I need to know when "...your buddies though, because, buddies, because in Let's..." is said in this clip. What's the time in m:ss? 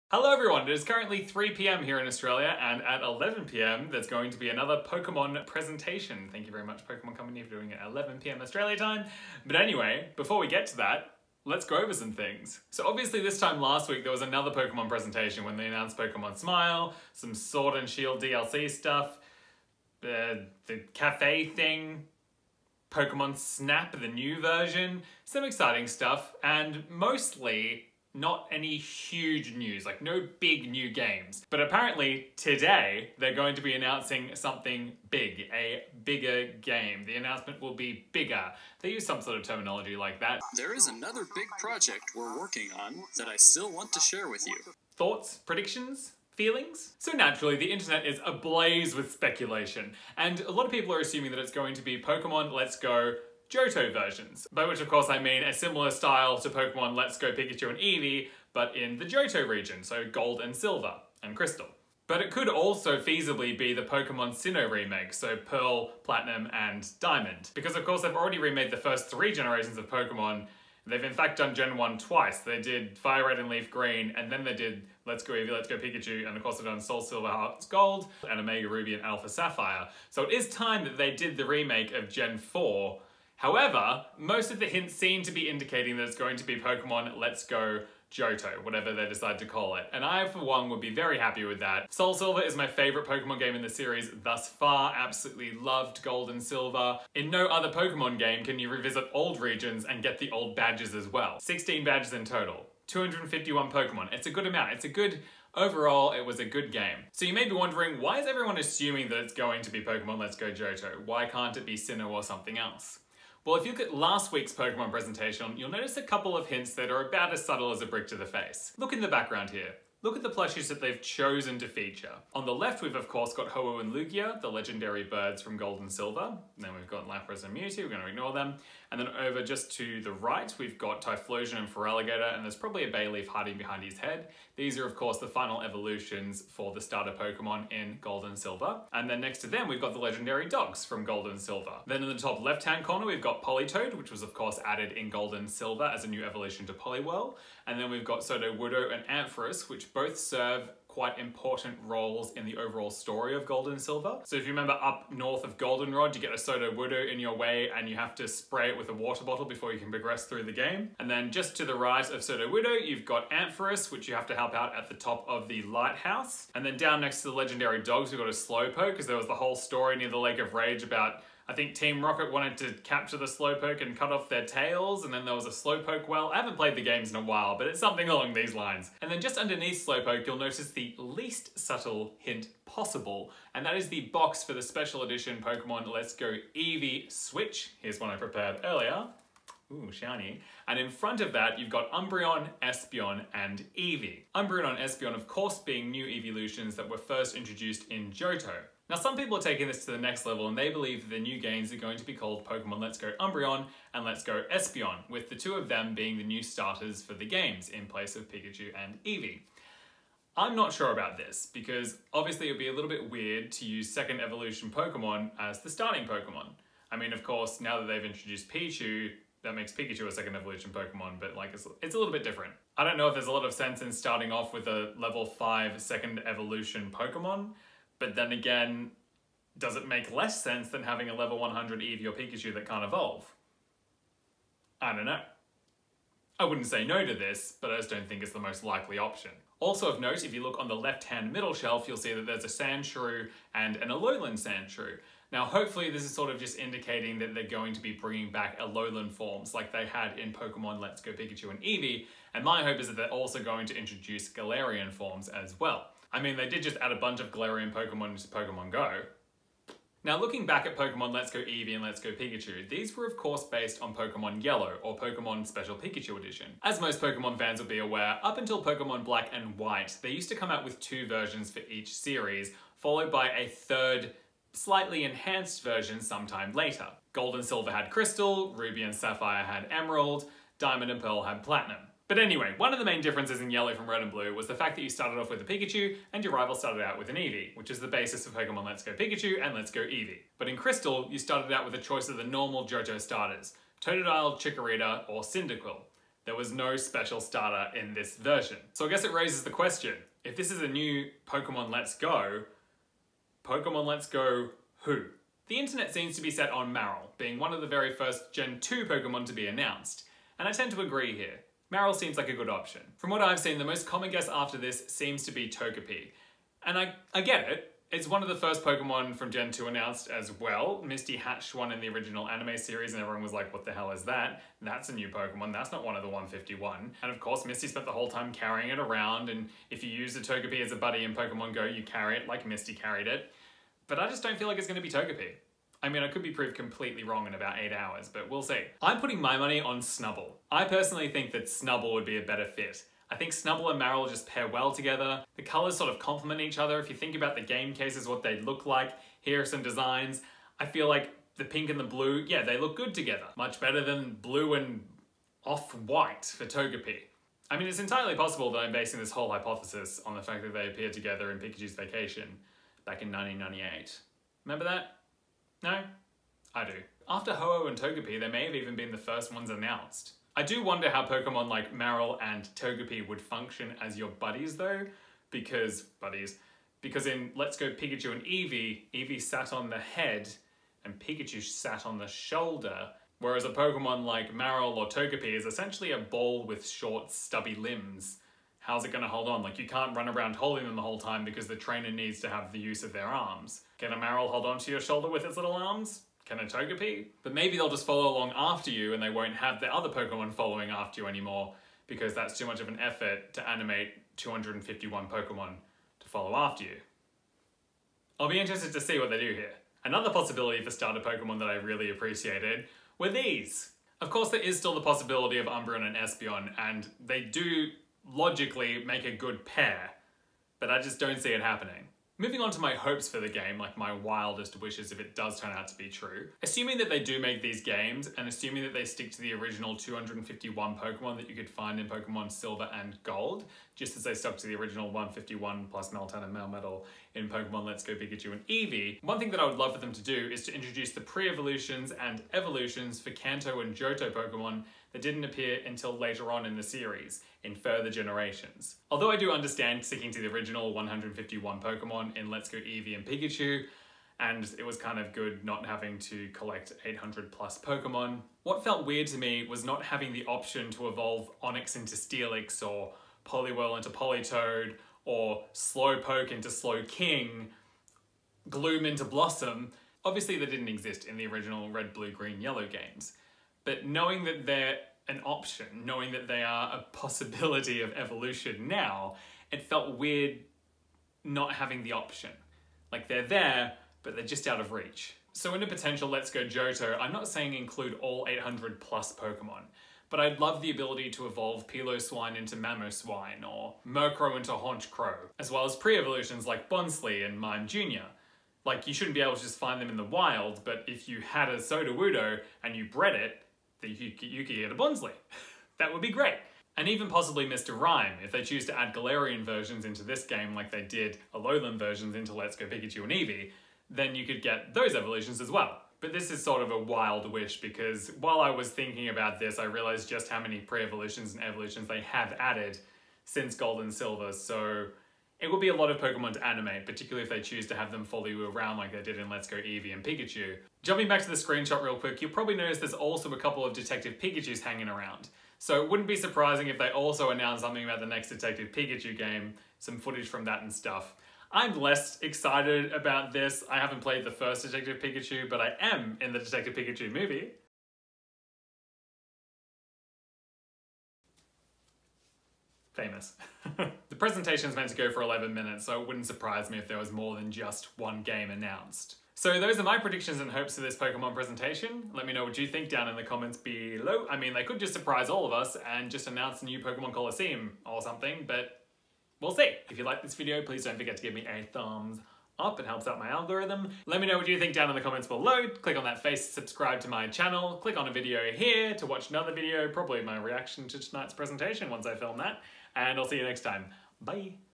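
6:13.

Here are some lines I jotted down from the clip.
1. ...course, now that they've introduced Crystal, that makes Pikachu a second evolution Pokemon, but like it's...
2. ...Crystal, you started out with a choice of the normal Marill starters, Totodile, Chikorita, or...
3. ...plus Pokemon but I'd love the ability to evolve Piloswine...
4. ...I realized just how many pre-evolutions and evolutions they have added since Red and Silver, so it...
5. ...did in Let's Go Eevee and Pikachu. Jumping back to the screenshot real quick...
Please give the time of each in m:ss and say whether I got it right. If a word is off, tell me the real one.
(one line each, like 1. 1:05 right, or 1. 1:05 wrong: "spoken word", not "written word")
1. 3:37 wrong: "Pichu", not "Crystal"
2. 4:50 wrong: "Johto", not "Marill"
3. 8:08 right
4. 8:39 wrong: "Gold", not "Red"
5. 8:49 right.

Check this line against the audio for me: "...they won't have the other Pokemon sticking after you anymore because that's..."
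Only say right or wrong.
wrong.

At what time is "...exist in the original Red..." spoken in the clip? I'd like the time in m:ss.
7:50.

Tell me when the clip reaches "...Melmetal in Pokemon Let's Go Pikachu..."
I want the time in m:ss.
7:16.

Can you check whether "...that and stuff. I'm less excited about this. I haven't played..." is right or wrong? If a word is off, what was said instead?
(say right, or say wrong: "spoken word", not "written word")
right.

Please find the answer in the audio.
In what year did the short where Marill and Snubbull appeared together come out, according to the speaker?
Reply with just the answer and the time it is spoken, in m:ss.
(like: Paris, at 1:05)
1998, at 6:02.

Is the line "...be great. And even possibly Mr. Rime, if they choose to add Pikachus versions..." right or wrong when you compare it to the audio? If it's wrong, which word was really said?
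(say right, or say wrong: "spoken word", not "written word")
wrong: "Galarian", not "Pikachus".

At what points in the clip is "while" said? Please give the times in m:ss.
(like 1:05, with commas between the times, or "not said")
2:57, 8:38.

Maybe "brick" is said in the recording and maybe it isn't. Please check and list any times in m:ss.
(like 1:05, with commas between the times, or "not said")
1:57.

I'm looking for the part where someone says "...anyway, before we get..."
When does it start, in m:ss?
0:09.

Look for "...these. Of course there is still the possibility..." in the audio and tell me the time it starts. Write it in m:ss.
6:53.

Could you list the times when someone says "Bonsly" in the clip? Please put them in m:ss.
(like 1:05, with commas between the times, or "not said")
8:16, 8:24.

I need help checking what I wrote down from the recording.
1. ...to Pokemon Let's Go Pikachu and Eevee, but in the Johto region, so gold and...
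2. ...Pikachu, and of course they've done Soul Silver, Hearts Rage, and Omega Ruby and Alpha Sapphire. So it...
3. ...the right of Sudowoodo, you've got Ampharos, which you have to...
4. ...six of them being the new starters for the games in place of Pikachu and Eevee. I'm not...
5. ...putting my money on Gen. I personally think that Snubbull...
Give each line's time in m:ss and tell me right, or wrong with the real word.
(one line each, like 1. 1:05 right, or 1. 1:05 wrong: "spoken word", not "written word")
1. 0:56 right
2. 1:15 wrong: "Gold", not "Rage"
3. 2:41 right
4. 3:25 wrong: "two", not "six"
5. 5:39 wrong: "Snubbull", not "Gen".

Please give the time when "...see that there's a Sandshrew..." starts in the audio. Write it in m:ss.
4:01.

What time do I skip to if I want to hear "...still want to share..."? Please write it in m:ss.
0:43.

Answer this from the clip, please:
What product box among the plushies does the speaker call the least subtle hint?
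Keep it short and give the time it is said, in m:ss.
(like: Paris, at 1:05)
Pokemon Let's Go Eevee Switch, at 3:05.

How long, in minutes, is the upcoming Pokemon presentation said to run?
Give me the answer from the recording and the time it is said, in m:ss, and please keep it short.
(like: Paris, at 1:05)
11 minutes, at 9:15.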